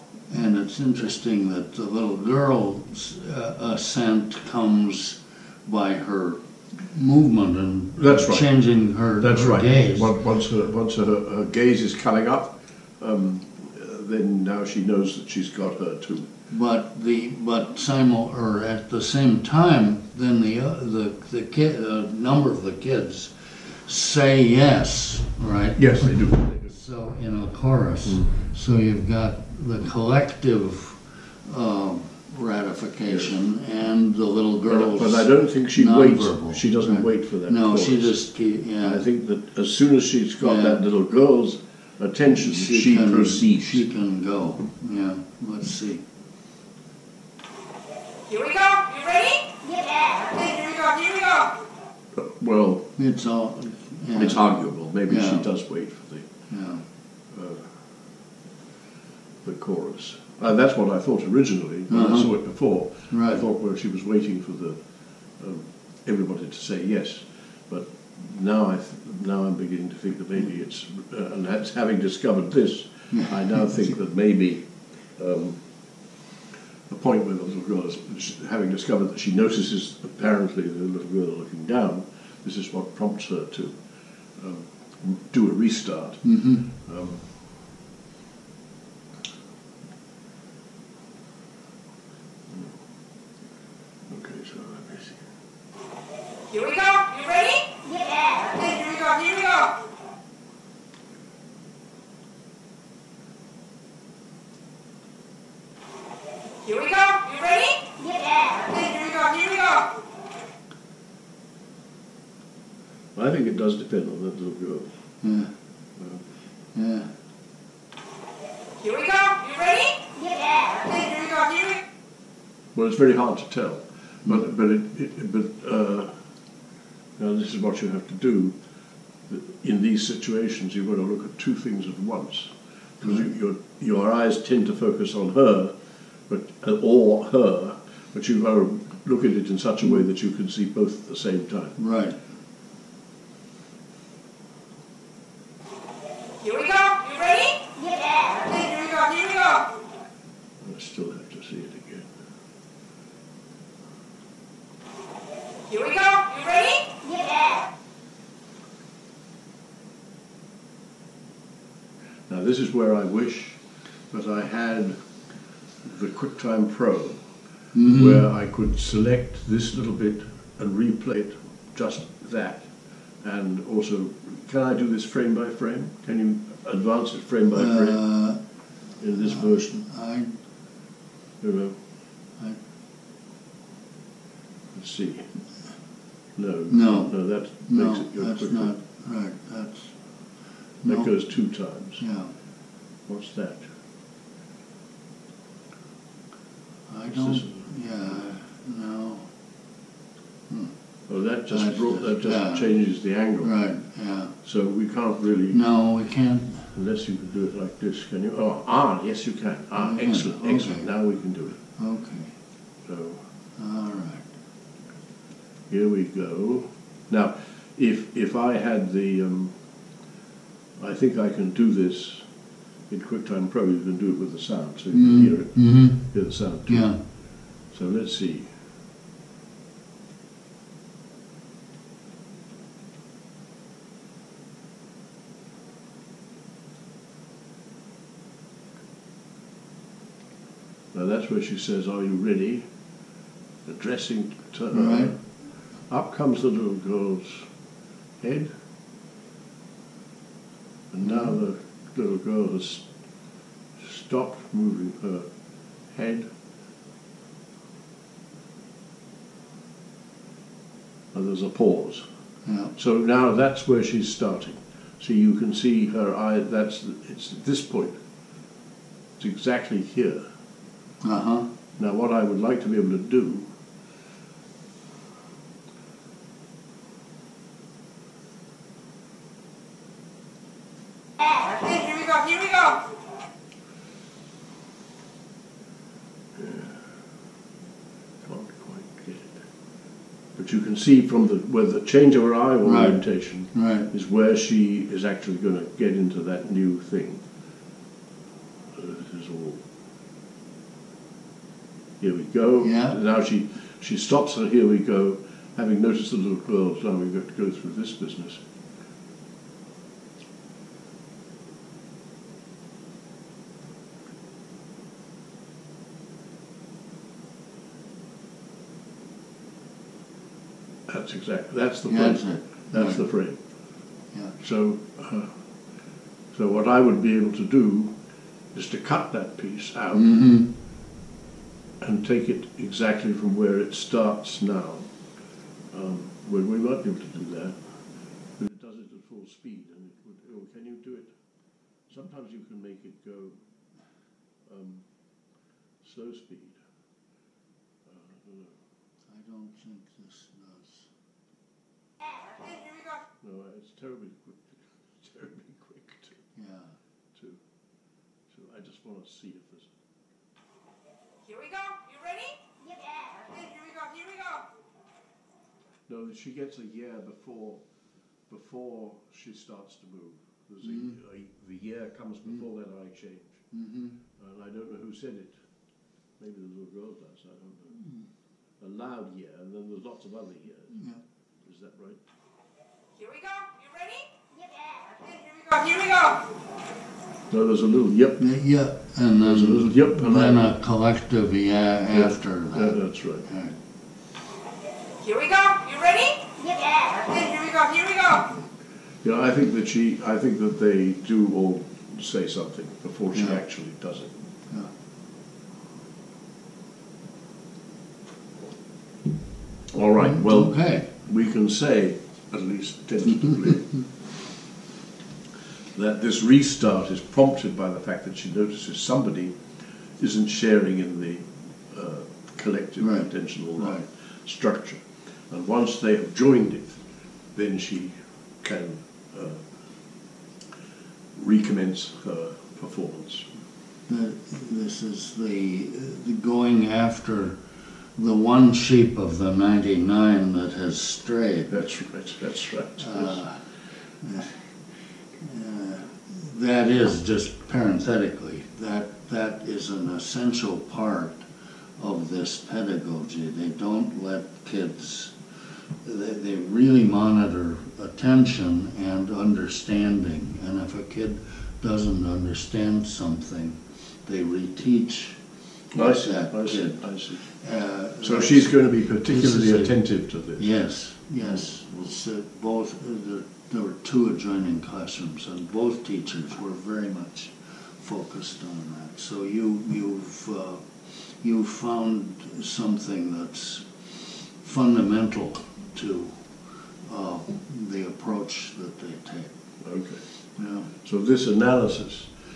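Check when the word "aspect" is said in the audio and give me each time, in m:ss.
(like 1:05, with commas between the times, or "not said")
not said.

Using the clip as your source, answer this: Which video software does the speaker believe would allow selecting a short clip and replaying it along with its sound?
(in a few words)
QuickTime Pro.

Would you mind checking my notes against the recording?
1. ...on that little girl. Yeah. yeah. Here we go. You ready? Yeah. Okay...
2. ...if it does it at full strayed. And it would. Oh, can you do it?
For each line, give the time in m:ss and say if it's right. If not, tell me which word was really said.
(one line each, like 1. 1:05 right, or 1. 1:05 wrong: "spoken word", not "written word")
1. 1:54 right
2. 5:38 wrong: "speed", not "strayed".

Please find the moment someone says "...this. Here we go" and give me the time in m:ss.
5:59.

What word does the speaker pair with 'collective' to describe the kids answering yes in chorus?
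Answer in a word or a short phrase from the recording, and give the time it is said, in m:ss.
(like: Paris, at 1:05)
ratification, at 0:32.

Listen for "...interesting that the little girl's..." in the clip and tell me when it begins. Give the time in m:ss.
0:00.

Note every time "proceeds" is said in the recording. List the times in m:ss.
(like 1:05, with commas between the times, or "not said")
0:43.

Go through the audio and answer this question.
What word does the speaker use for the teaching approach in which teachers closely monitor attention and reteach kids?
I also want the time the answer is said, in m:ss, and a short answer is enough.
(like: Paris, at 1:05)
pedagogy, at 7:32.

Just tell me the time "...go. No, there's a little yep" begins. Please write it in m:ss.
6:25.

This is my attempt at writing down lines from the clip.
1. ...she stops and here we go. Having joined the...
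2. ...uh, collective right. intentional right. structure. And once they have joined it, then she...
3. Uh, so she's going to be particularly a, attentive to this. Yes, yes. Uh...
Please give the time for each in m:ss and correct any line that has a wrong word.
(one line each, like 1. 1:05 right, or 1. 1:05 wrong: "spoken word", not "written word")
1. 5:03 wrong: "noticed", not "joined"
2. 7:01 right
3. 7:47 right.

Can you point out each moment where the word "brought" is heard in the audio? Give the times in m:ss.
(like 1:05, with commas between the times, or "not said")
3:21.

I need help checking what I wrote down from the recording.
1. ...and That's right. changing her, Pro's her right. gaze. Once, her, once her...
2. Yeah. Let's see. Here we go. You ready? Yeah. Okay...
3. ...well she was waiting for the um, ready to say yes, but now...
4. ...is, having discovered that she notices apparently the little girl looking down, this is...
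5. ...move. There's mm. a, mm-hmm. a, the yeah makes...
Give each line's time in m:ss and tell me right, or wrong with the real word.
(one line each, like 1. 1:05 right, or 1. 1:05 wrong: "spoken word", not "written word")
1. 0:07 wrong: "That", not "Pro"
2. 0:44 right
3. 1:03 wrong: "everybody", not "ready"
4. 1:17 right
5. 6:09 wrong: "comes", not "makes".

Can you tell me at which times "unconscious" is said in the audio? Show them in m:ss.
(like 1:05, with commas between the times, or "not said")
not said.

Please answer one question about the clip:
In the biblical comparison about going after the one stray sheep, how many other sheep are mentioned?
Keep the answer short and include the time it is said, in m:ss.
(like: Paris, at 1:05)
99, at 7:19.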